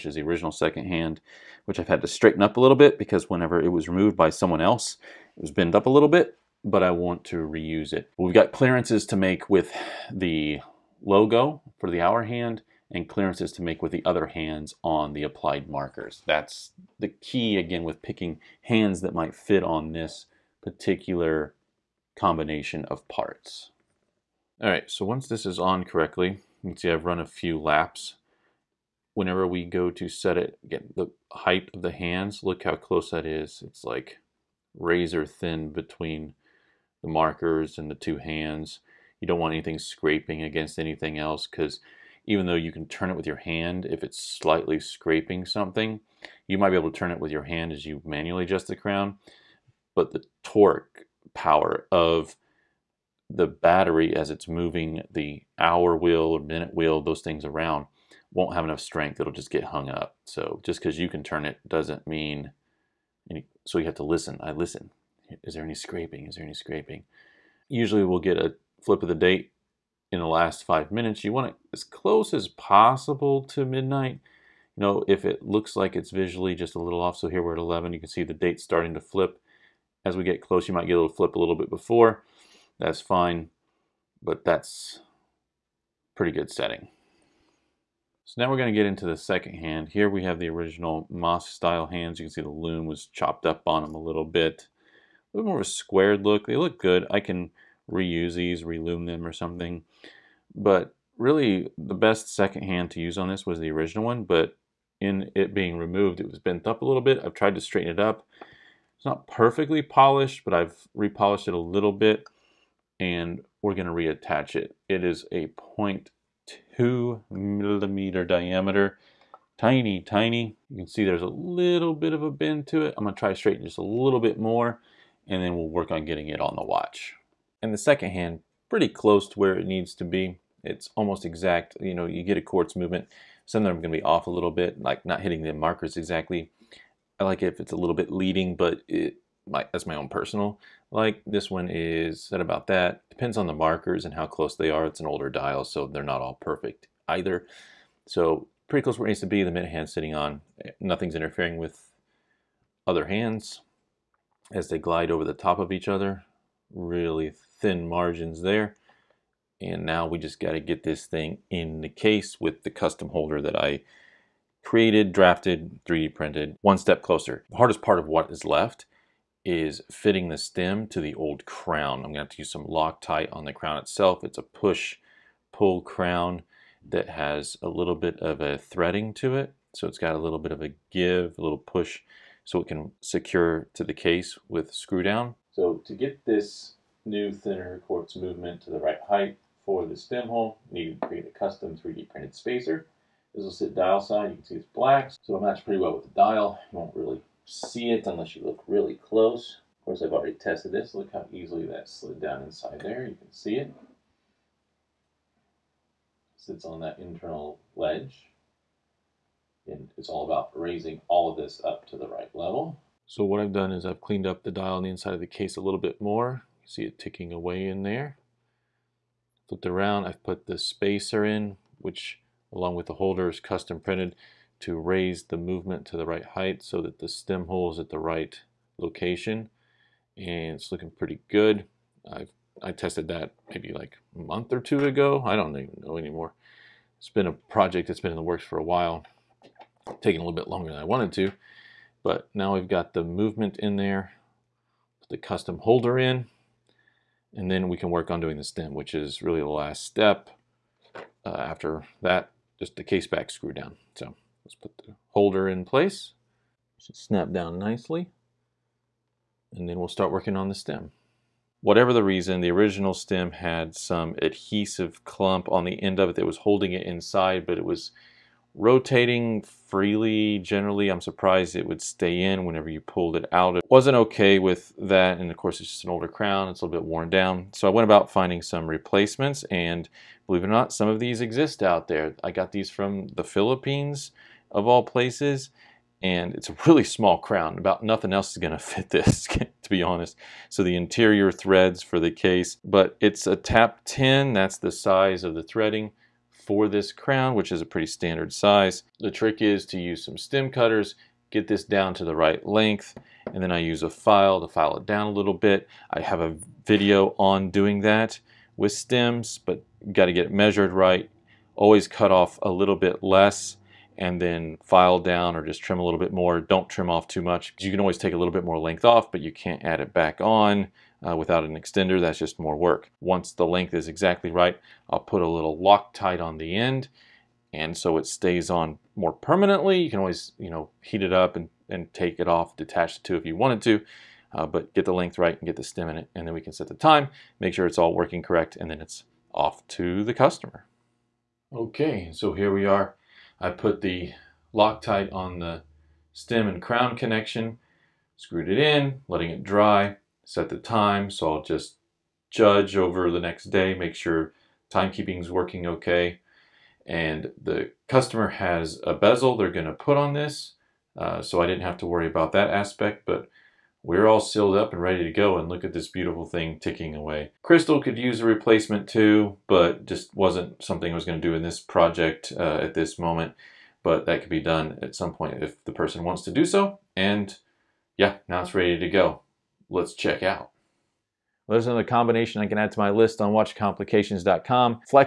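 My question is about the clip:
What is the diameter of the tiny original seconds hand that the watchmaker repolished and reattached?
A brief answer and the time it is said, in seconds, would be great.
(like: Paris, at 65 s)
0.2 millimeter, at 115 s.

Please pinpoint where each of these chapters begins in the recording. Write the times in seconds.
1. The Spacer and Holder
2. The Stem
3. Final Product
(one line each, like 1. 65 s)
1. 177 s
2. 271 s
3. 351 s.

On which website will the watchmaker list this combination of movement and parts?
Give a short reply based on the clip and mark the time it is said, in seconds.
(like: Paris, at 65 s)
watchcomplications.com, at 383 s.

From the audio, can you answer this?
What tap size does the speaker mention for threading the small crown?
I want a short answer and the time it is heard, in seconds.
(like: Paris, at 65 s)
tap 10, at 293 s.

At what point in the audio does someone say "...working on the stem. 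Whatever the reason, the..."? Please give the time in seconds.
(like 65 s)
260 s.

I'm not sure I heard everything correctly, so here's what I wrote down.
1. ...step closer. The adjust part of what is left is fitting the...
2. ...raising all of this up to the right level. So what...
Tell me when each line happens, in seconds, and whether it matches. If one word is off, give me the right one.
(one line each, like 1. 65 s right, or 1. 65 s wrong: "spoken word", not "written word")
1. 166 s wrong: "hardest", not "adjust"
2. 210 s right.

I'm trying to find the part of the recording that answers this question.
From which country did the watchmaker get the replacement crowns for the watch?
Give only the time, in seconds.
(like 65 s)
283 s.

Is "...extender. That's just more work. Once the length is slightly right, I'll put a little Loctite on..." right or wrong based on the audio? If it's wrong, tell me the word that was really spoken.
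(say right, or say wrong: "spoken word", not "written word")
wrong: "exactly", not "slightly".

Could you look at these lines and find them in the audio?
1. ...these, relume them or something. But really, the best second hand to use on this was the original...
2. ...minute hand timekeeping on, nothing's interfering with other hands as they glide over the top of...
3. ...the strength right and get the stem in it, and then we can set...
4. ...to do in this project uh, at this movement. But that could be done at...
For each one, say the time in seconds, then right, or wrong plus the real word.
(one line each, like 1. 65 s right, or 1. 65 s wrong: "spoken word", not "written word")
1. 98 s right
2. 149 s wrong: "sitting", not "timekeeping"
3. 334 s wrong: "length", not "strength"
4. 371 s wrong: "moment", not "movement".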